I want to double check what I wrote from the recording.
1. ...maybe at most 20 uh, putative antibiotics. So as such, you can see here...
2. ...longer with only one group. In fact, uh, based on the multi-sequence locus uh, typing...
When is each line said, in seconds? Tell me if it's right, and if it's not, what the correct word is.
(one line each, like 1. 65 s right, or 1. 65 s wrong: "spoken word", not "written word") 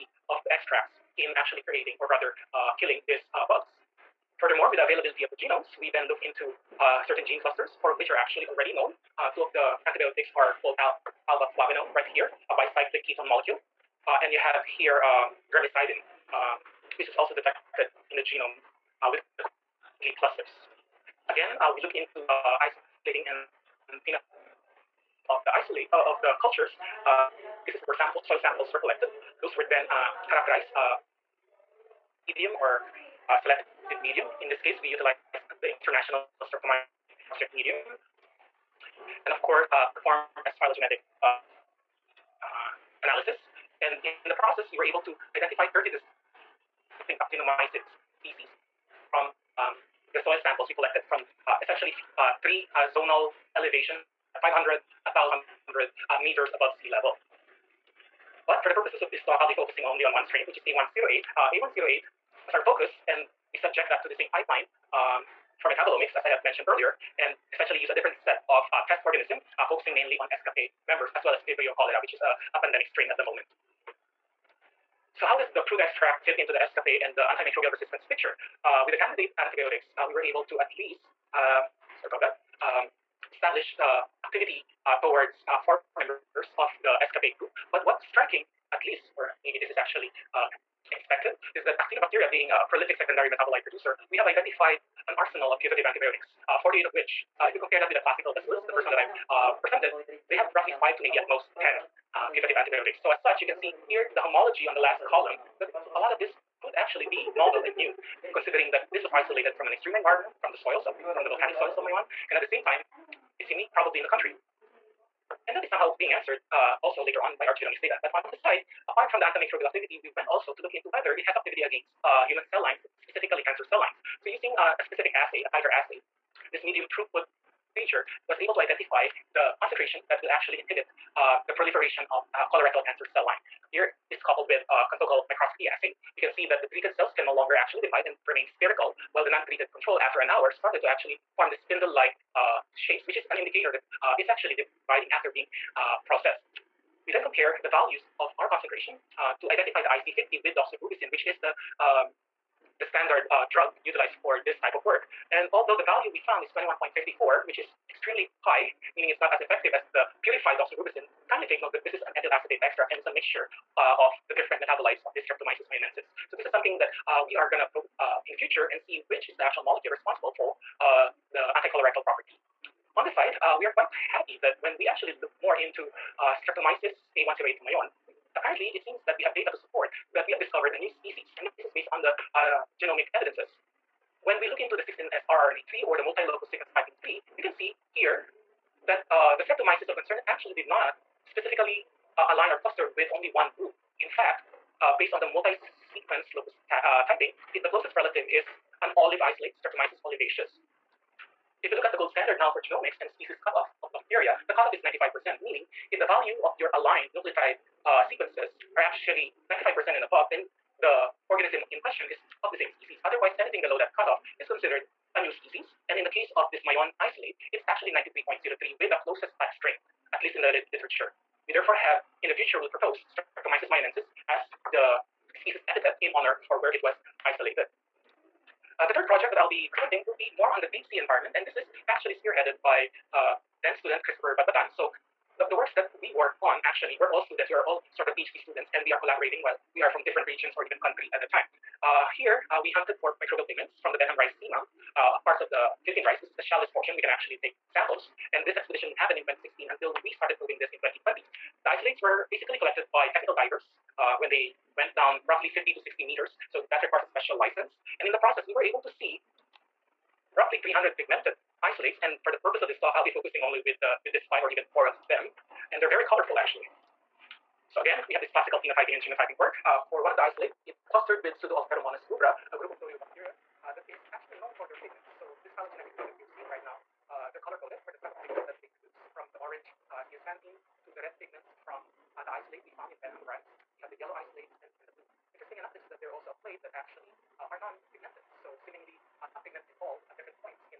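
1. 101 s wrong: "10", not "20"
2. 192 s wrong: "cluster", not "longer".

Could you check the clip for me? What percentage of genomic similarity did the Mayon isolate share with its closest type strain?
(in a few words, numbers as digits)
93.03%.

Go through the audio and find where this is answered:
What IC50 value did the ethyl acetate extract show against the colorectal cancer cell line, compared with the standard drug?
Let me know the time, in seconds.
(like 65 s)
156 s.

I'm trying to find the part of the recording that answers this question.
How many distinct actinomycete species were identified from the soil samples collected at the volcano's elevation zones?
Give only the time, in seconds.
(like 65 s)
45 s.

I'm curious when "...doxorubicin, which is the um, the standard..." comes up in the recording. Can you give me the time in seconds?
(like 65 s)
150 s.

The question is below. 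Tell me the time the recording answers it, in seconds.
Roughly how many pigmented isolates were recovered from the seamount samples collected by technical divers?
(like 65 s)
260 s.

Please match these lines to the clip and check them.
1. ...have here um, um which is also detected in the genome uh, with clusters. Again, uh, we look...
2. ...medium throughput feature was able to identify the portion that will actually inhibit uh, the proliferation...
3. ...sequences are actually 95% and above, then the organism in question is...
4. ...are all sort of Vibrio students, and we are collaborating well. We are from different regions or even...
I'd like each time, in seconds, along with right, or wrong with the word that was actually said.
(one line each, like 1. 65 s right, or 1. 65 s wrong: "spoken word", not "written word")
1. 14 s right
2. 126 s wrong: "concentration", not "portion"
3. 208 s right
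4. 237 s wrong: "PhD", not "Vibrio".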